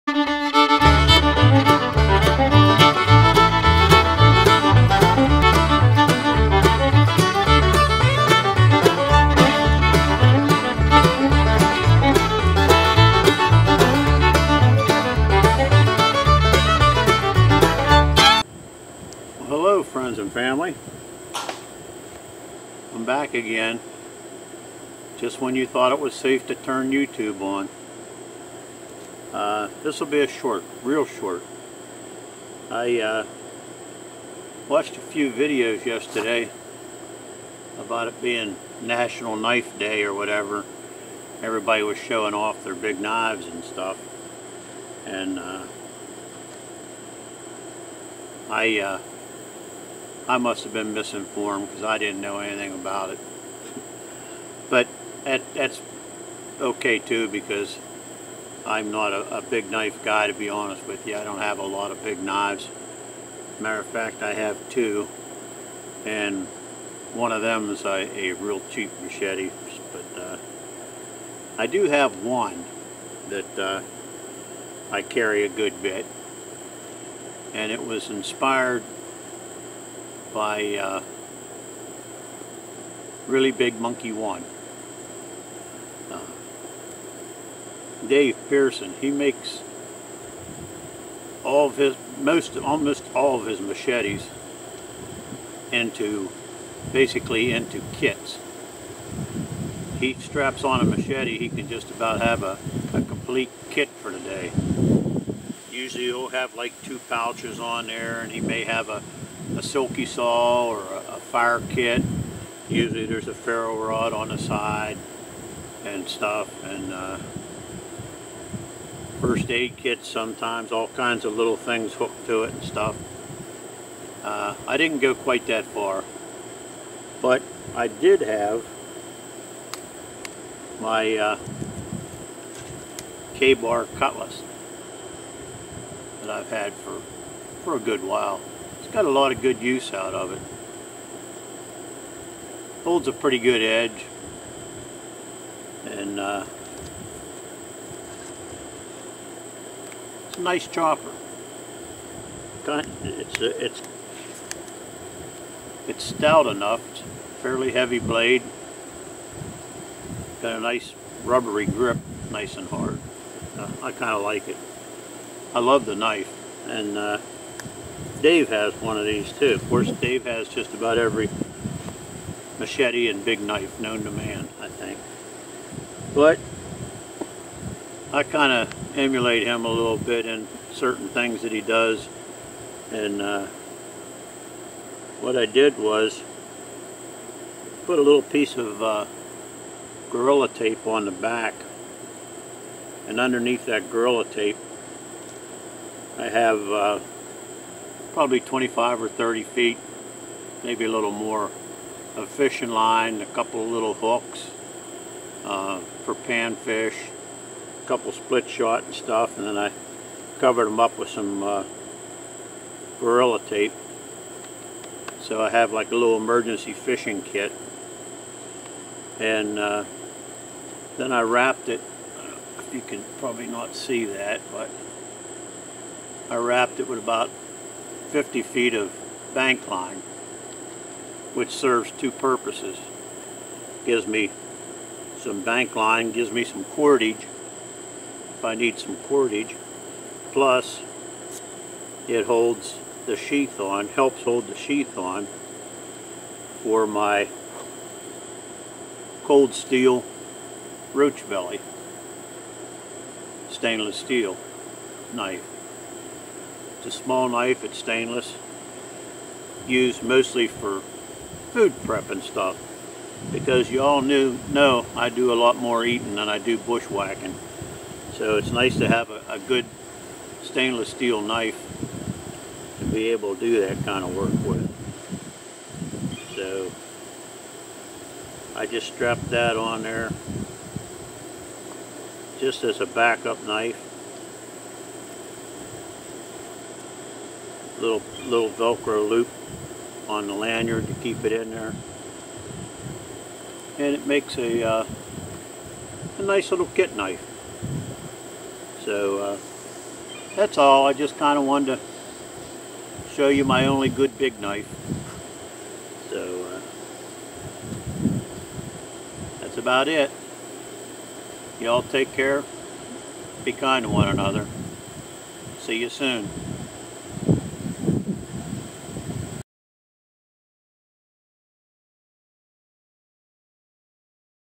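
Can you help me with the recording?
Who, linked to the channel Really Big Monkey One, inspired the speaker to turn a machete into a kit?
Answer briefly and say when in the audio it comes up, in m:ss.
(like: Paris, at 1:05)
Dave Pearson, at 1:28.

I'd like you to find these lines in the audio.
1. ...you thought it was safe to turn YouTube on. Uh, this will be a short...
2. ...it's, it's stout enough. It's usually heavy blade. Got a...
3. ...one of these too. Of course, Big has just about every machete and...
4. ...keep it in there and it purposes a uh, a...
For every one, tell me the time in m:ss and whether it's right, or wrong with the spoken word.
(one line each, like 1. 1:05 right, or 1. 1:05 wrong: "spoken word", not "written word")
1. 0:25 right
2. 2:33 wrong: "fairly", not "usually"
3. 2:48 wrong: "Dave", not "Big"
4. 4:50 wrong: "makes", not "purposes".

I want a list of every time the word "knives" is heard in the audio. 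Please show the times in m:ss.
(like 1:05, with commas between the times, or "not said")
0:43, 1:02.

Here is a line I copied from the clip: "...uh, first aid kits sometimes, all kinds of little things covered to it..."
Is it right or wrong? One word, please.
wrong.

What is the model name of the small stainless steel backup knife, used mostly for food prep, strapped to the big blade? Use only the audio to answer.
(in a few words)
Roach Belly.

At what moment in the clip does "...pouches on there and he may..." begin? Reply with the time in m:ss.
1:47.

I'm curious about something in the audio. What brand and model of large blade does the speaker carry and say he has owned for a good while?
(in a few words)
Ka-Bar cutlass.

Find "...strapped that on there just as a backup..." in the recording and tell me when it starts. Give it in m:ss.
4:38.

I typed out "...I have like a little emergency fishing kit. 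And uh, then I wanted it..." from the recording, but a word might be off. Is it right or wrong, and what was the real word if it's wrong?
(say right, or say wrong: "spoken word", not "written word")
wrong: "wrapped", not "wanted".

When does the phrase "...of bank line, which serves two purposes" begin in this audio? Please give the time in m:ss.
3:48.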